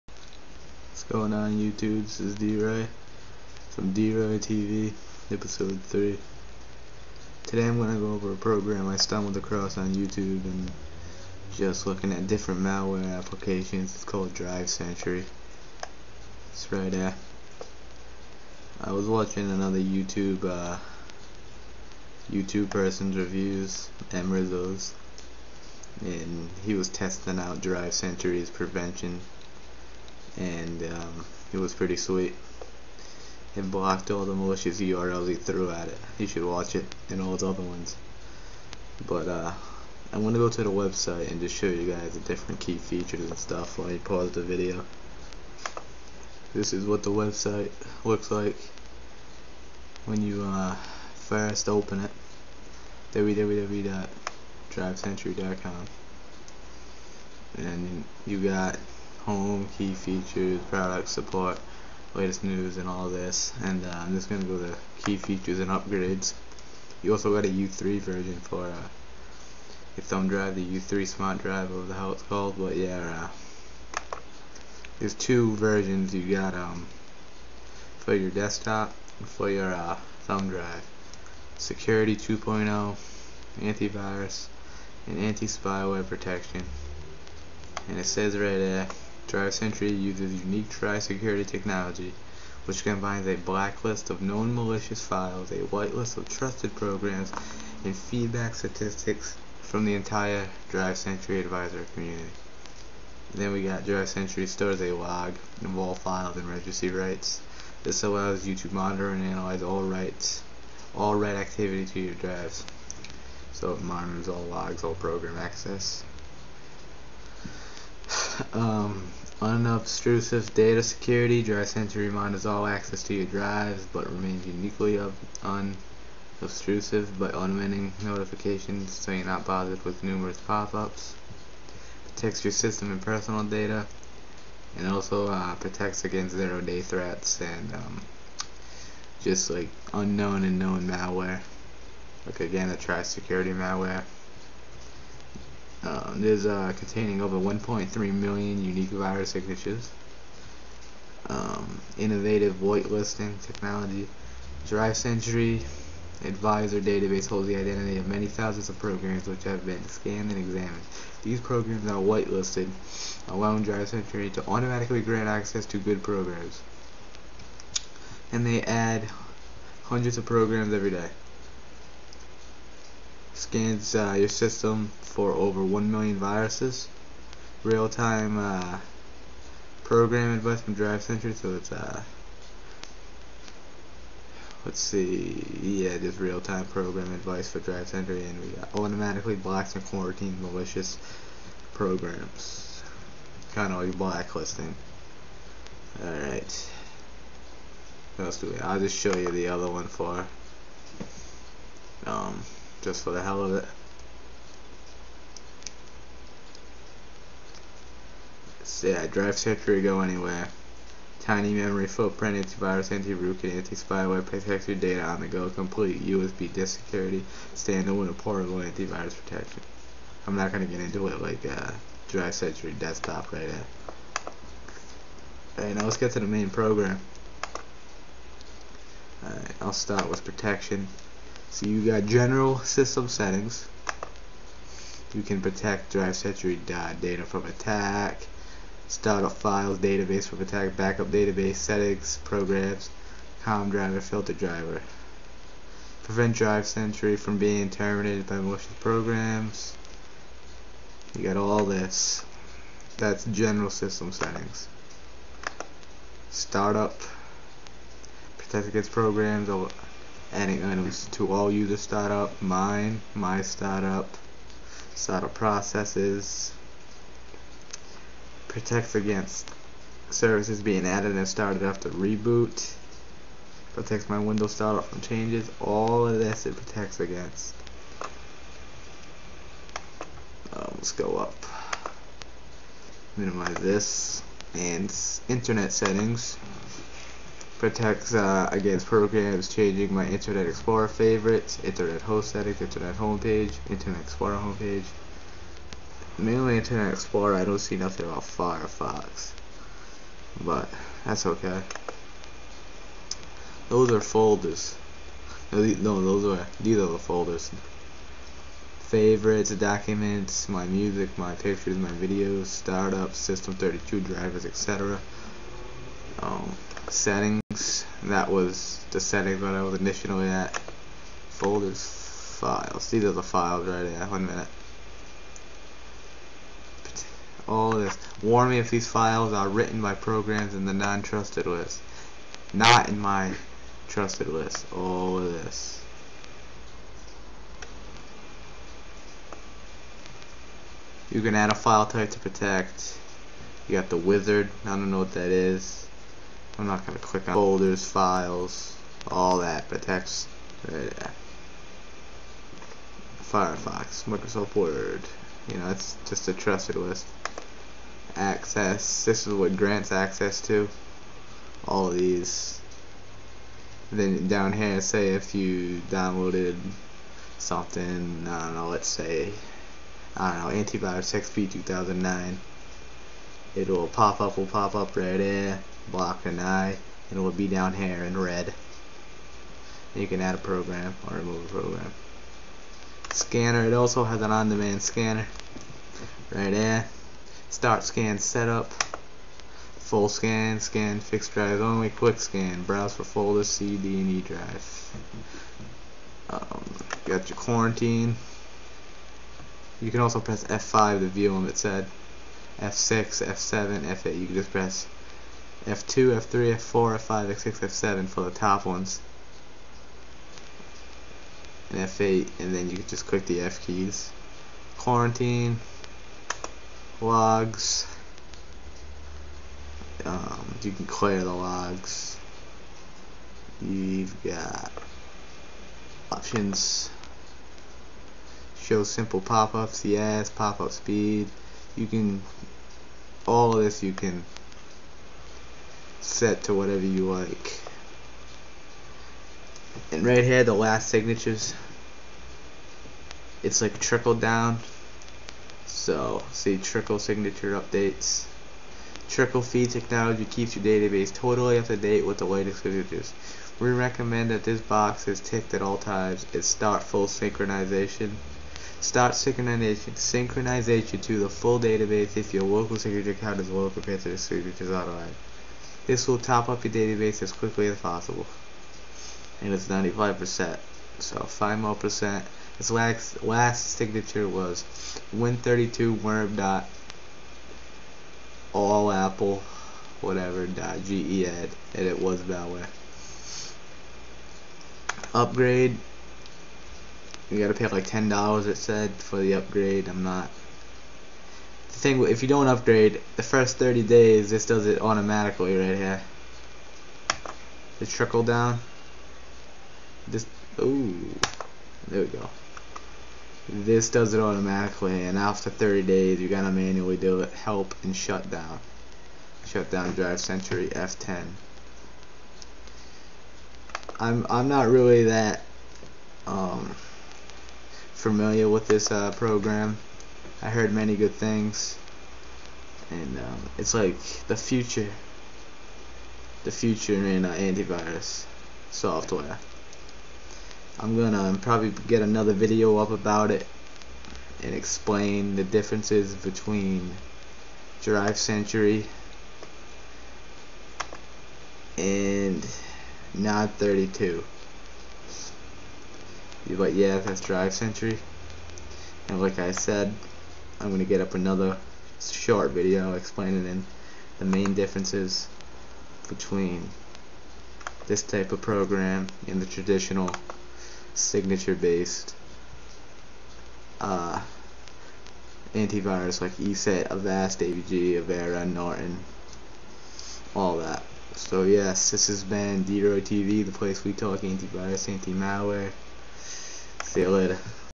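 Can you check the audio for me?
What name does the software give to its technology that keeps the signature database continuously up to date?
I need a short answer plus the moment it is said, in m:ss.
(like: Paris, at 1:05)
Trickle feed, at 7:29.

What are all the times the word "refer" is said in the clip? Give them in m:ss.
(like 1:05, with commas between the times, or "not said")
not said.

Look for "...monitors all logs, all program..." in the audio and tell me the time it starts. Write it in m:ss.
1:53.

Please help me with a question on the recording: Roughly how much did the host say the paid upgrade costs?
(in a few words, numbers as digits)
$10.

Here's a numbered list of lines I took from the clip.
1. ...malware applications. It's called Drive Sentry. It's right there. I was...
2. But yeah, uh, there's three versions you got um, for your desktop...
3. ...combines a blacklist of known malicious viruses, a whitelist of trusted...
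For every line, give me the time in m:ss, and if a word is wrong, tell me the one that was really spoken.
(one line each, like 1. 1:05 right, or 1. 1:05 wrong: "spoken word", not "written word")
1. 0:12 right
2. 1:12 wrong: "two", not "three"
3. 1:32 wrong: "files", not "viruses".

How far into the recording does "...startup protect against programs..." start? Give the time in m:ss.
4:16.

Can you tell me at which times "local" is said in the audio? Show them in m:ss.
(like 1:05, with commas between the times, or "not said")
7:42.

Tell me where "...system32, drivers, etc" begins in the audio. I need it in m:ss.
5:13.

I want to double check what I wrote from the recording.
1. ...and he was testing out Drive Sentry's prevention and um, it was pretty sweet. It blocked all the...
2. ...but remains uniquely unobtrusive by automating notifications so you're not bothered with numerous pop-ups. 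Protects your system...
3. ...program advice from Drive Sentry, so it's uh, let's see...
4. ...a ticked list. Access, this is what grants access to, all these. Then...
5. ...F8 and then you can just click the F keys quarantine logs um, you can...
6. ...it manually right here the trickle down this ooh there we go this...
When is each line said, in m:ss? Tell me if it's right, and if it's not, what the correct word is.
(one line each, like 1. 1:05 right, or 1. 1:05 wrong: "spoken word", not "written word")
1. 0:25 right
2. 2:03 right
3. 2:59 right
4. 5:56 wrong: "trusted", not "ticked"
5. 6:51 right
6. 8:14 wrong: "automatically", not "manually".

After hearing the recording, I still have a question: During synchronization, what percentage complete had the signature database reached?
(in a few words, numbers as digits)
95%.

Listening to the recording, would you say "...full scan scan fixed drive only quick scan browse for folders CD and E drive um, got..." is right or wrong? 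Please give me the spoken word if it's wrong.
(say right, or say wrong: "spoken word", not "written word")
right.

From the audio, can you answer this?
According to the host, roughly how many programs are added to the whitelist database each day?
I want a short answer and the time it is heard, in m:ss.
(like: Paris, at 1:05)
Hundreds, at 2:49.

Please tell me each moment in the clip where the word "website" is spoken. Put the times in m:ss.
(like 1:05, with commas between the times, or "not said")
0:40, 0:47.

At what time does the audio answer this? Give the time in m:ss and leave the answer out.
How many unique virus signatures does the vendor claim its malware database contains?
2:27.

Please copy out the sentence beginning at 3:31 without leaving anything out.
Tiny memory footprint, antivirus, anti-root, and anti-spyware protects your data on the go.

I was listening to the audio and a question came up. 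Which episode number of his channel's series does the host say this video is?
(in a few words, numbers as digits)
3.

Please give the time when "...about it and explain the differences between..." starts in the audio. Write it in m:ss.
8:52.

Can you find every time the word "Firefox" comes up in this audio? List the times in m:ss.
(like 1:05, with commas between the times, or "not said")
4:58, 5:53.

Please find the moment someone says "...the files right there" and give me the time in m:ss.
5:23.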